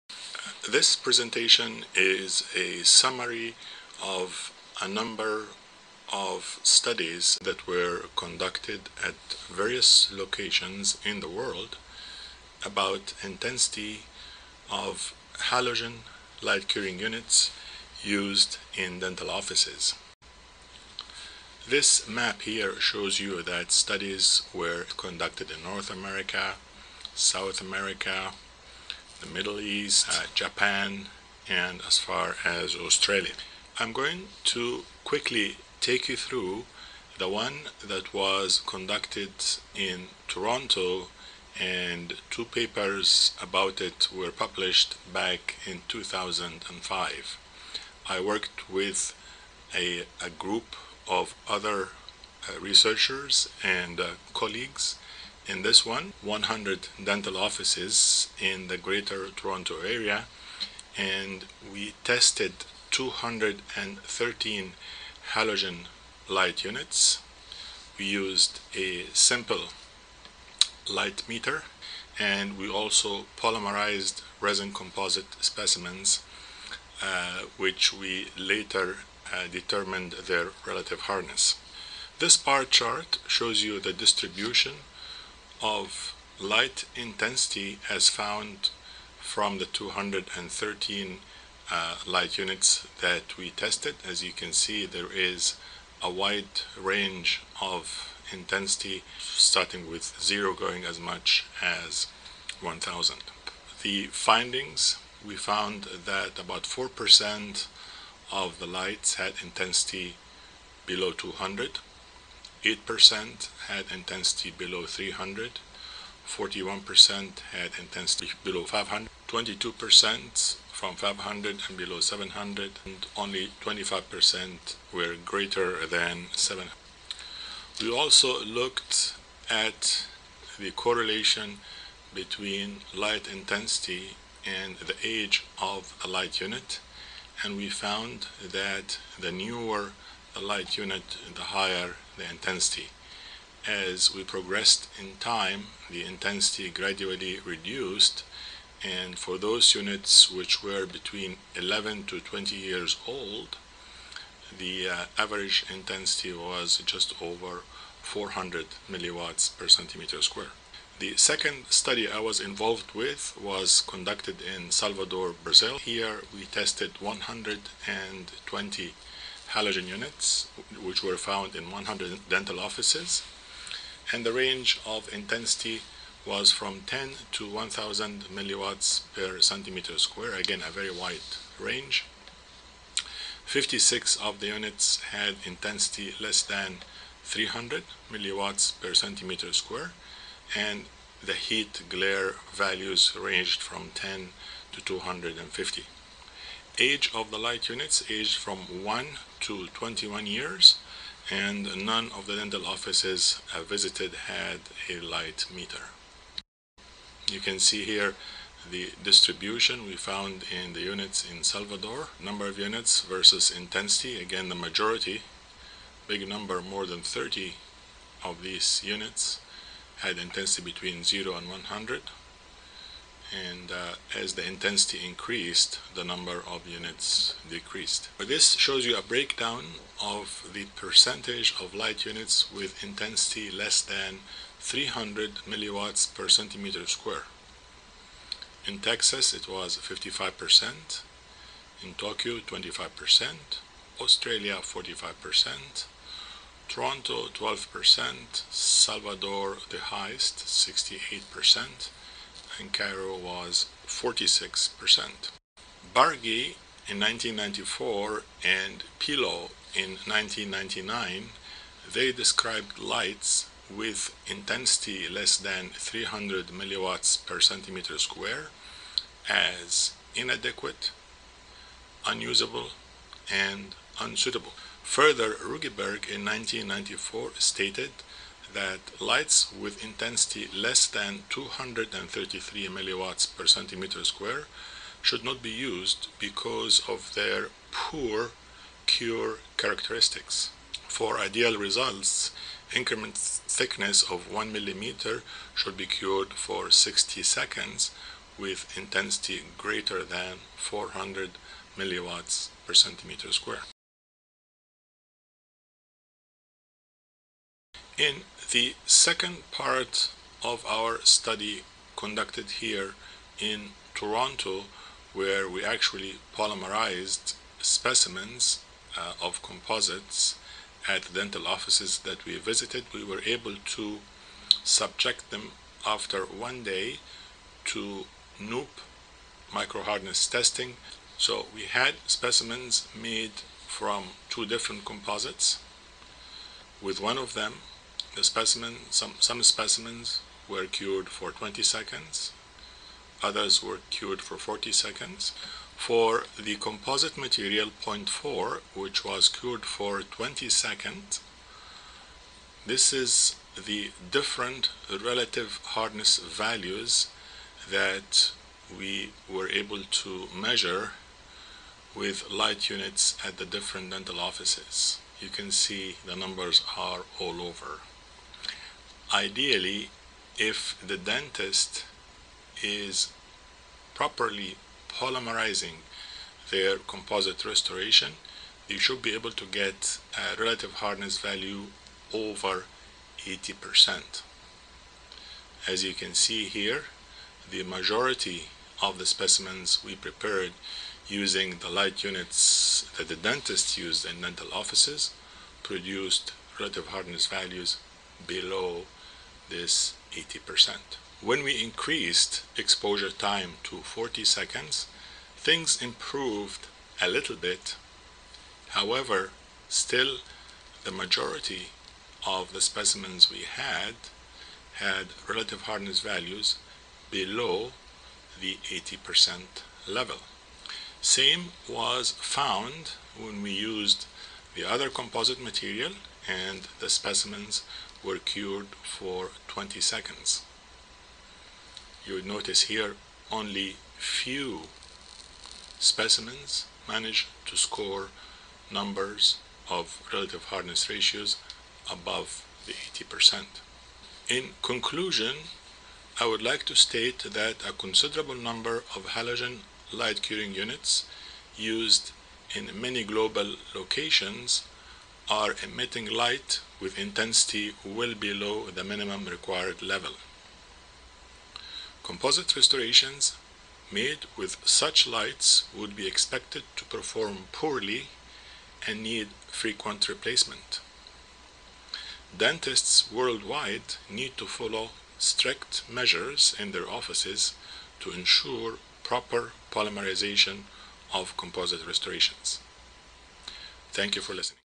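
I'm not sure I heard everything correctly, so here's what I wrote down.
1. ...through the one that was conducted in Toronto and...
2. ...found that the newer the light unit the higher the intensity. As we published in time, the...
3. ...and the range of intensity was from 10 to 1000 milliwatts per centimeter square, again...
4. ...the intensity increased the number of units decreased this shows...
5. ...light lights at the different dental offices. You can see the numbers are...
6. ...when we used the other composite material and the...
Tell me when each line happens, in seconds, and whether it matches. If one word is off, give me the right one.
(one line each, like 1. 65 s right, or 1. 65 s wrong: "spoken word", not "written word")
1. 36 s right
2. 137 s wrong: "progressed", not "published"
3. 174 s right
4. 224 s right
5. 362 s wrong: "units", not "lights"
6. 423 s right.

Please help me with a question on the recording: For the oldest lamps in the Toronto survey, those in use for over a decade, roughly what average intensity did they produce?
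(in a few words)
just over 400.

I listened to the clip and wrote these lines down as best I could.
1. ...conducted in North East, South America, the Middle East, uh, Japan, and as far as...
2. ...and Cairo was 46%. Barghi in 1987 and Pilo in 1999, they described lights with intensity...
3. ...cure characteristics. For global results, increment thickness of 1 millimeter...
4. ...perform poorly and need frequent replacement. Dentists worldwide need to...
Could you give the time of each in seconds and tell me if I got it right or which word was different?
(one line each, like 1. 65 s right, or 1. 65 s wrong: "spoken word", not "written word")
1. 24 s wrong: "America", not "East"
2. 252 s wrong: "1994", not "1987"
3. 288 s wrong: "ideal", not "global"
4. 466 s right.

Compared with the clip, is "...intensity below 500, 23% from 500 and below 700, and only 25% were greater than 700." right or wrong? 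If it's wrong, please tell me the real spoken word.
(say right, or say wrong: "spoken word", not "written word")
wrong: "22", not "23".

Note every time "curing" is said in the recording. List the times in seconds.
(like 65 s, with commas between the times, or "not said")
16 s, 450 s.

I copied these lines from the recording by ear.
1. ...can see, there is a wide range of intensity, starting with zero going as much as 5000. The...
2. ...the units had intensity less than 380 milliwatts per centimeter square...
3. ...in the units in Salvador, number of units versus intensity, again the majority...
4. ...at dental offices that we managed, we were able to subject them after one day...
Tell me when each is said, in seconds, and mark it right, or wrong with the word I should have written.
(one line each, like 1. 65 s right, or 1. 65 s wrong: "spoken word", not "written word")
1. 94 s wrong: "1000", not "5000"
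2. 184 s wrong: "300", not "380"
3. 210 s right
4. 320 s wrong: "visited", not "managed".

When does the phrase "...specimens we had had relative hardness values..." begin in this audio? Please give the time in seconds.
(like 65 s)
412 s.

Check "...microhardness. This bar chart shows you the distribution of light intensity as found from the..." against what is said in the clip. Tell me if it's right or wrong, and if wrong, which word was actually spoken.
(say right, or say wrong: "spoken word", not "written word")
wrong: "hardness", not "microhardness".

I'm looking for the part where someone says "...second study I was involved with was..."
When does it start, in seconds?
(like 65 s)
161 s.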